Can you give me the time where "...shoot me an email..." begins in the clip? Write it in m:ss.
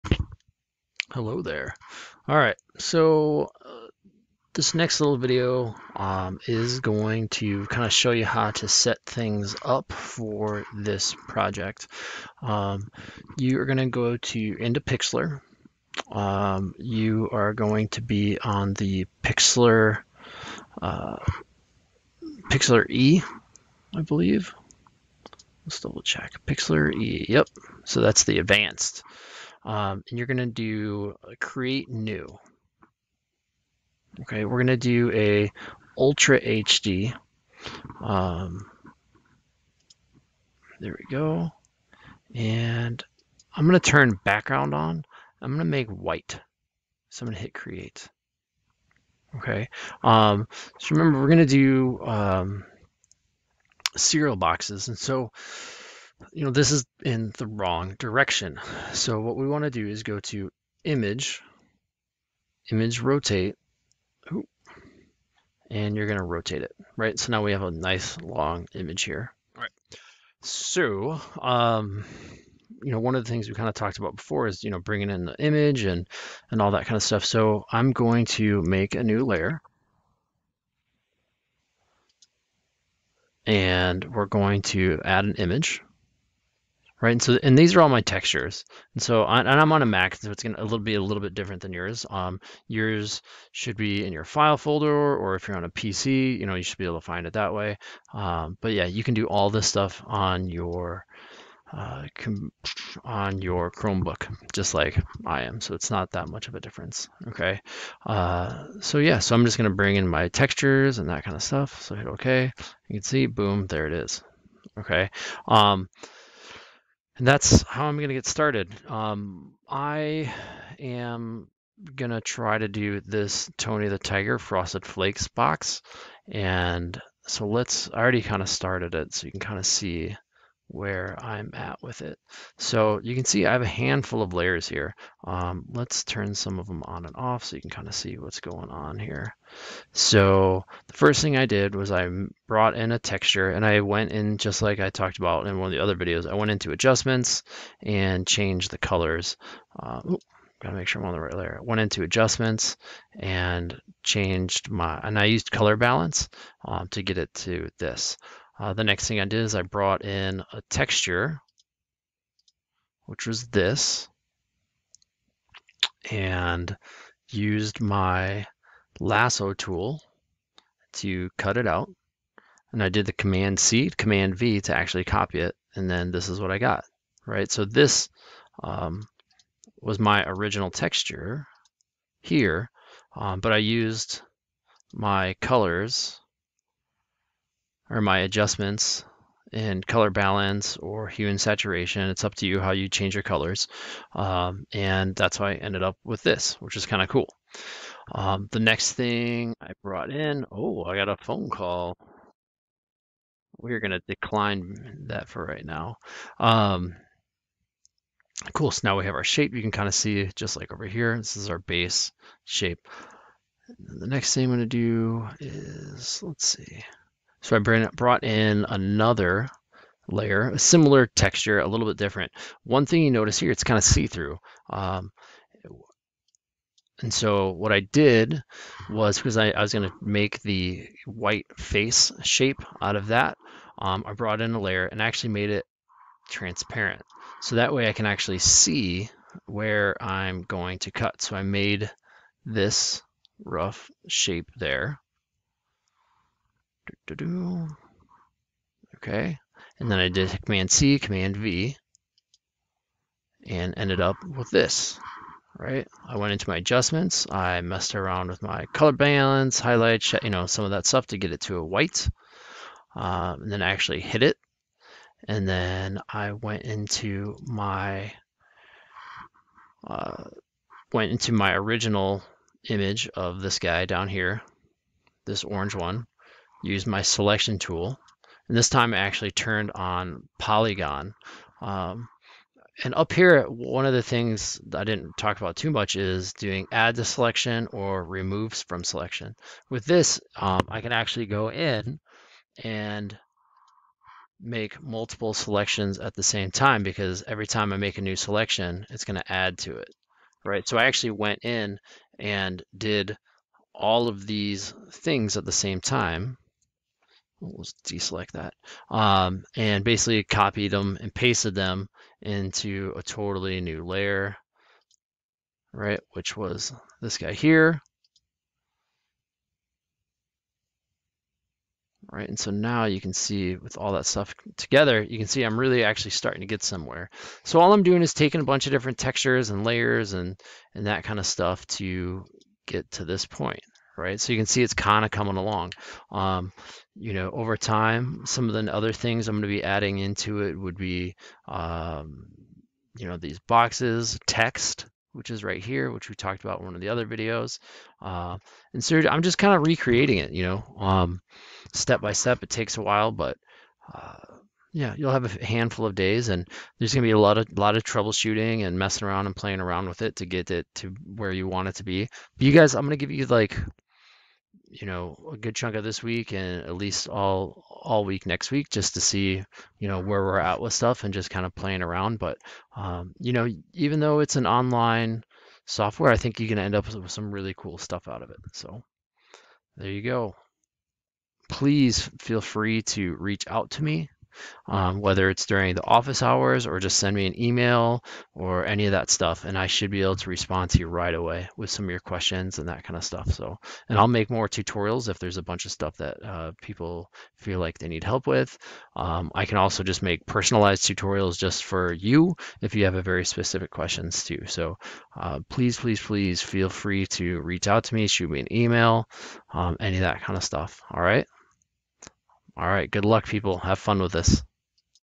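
6:48.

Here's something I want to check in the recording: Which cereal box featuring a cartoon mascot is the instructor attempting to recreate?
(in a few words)
Frosted Flakes.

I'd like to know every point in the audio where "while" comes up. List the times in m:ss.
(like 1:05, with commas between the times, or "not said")
5:52.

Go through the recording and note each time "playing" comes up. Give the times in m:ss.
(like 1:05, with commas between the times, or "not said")
5:59, 6:11.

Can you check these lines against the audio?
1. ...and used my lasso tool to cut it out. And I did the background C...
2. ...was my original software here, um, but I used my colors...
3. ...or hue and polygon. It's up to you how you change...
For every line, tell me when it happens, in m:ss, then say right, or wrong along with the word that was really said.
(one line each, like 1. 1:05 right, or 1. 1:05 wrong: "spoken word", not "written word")
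1. 2:46 wrong: "command", not "background"
2. 2:59 wrong: "texture", not "software"
3. 3:10 wrong: "saturation", not "polygon".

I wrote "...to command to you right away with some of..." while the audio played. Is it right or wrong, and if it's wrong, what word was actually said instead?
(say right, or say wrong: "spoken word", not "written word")
wrong: "respond", not "command".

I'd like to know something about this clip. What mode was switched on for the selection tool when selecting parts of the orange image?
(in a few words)
Polygon.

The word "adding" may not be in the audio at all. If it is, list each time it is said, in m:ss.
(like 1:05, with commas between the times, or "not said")
5:39.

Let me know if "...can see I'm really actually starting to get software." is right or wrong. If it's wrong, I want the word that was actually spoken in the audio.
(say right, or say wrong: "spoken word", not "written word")
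wrong: "somewhere", not "software".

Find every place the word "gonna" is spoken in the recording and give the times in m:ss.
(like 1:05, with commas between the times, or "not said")
1:30, 3:49.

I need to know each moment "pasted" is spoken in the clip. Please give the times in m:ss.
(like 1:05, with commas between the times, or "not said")
5:11.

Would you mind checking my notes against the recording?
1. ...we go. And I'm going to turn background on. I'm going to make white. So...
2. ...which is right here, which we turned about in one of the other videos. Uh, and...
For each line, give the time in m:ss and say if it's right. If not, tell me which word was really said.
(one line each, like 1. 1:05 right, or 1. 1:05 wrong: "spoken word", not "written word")
1. 0:40 right
2. 5:45 wrong: "talked", not "turned".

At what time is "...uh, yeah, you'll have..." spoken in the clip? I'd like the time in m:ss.
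5:53.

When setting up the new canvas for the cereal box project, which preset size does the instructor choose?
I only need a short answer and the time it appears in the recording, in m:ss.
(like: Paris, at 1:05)
Ultra HD, at 0:35.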